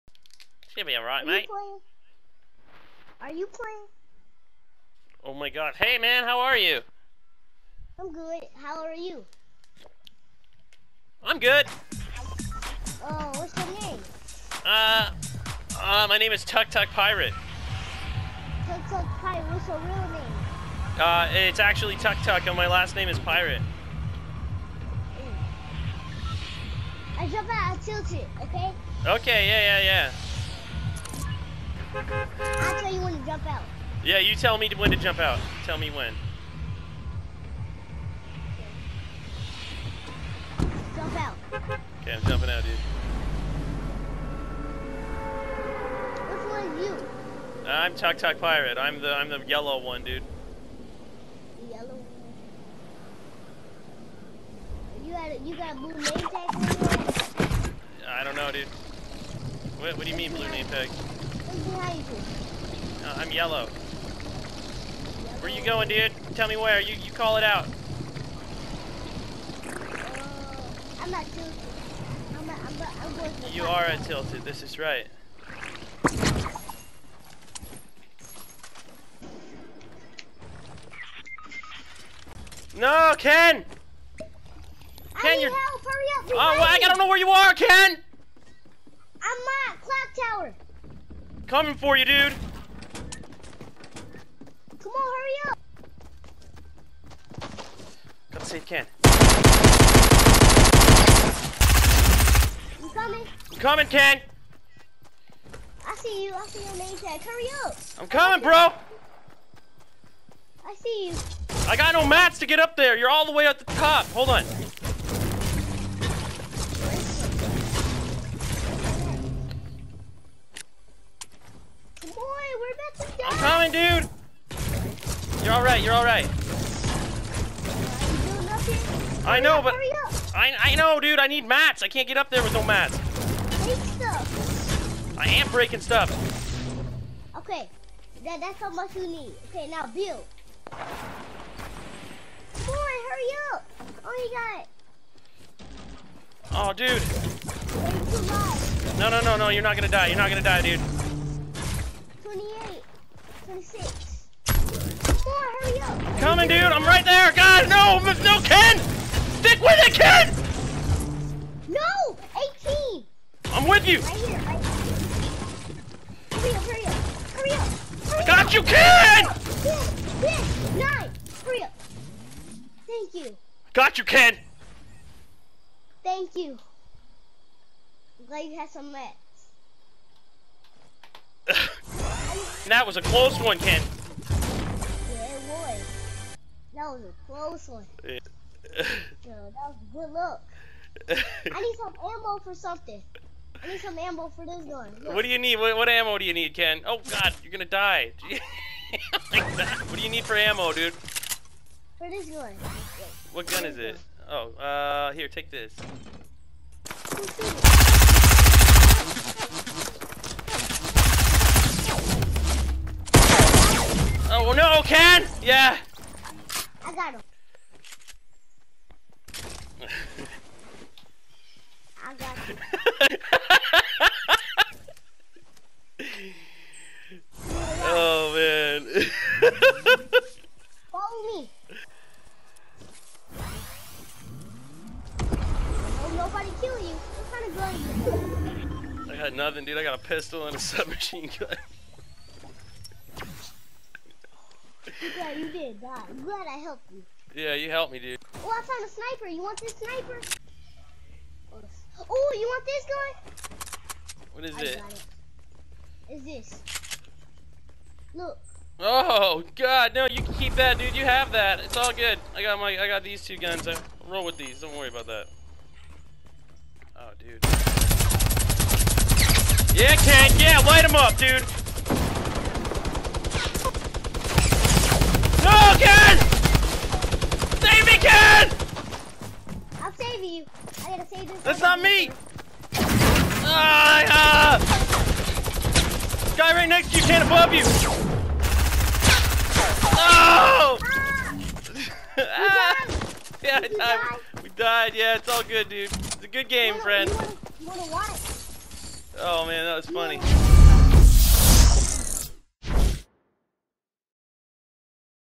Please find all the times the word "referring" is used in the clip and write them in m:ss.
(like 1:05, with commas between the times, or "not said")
not said.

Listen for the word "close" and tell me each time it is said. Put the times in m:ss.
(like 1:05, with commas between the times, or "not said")
3:03, 3:07.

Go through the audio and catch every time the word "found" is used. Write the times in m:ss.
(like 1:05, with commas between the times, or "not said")
4:08.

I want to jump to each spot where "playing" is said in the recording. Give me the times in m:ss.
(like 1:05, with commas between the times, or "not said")
0:03.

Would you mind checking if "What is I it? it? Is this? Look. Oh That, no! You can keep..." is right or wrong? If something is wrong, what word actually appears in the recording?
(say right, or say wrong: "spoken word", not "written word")
wrong: "God", not "That".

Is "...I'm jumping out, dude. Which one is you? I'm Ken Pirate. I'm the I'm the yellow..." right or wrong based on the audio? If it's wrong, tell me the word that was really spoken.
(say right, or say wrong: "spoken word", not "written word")
wrong: "TukTuk", not "Ken".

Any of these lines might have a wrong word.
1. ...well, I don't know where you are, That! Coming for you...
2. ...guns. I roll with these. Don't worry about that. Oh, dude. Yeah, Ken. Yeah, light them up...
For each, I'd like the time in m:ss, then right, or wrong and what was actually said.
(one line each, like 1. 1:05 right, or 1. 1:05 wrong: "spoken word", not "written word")
1. 1:26 wrong: "Ken", not "That"
2. 4:23 right.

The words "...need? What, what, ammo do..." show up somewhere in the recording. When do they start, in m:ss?
3:15.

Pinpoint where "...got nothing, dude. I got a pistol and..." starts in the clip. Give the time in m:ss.
3:59.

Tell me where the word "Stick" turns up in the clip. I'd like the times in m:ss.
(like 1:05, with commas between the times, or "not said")
2:39.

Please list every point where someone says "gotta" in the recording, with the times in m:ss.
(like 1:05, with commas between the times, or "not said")
4:40.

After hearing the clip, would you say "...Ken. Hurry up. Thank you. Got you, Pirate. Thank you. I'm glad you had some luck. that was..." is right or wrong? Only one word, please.
wrong.